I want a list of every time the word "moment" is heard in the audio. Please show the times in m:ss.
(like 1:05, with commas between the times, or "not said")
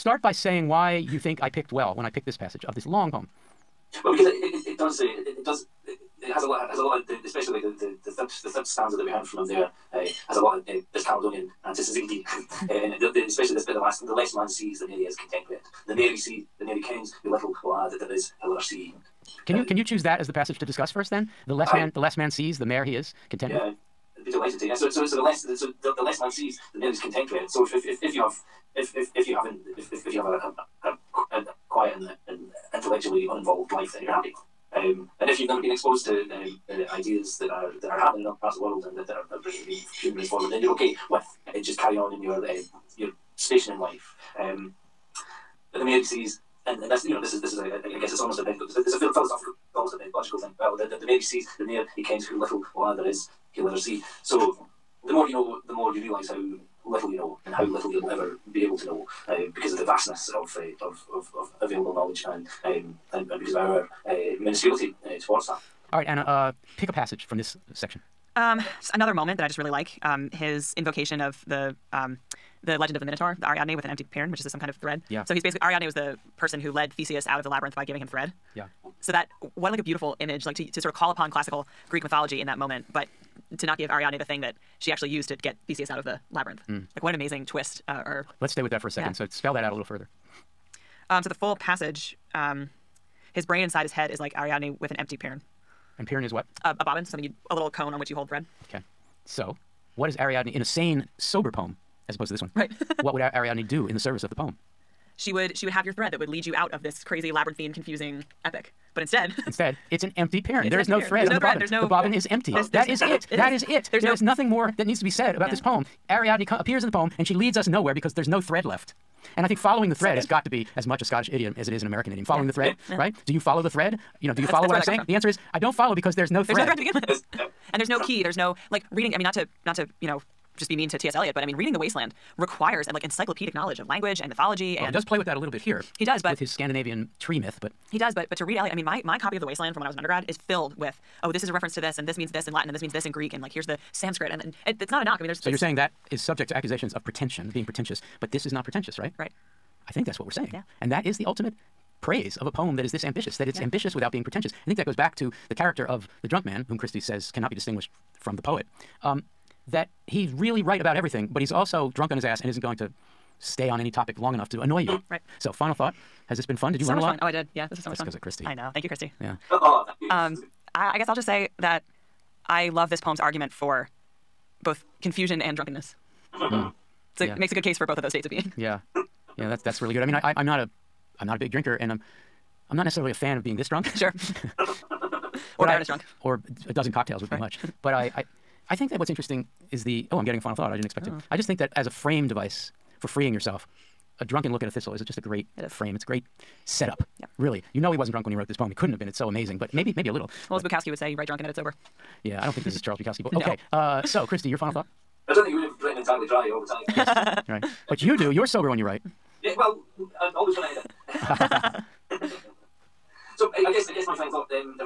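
1:09, 1:22.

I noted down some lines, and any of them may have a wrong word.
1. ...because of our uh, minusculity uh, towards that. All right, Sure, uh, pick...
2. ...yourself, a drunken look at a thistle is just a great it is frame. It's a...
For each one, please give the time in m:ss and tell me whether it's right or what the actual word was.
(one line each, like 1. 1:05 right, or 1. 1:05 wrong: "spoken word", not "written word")
1. 1:03 wrong: "Anna", not "Sure"
2. 3:13 right.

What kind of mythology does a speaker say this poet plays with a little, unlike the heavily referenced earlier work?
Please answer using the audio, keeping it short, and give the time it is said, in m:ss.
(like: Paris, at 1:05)
Scandinavian tree myth, at 2:16.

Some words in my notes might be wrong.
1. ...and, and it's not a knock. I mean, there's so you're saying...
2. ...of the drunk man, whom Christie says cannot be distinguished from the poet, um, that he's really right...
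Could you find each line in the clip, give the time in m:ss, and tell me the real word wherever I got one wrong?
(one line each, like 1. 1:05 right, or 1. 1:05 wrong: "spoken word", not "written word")
1. 2:24 right
2. 2:35 right.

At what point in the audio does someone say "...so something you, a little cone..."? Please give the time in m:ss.
1:37.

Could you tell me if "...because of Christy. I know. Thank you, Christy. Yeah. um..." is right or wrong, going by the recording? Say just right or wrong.
right.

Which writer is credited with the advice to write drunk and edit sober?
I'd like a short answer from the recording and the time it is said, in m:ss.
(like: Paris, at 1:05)
Charles Bukowski, at 3:22.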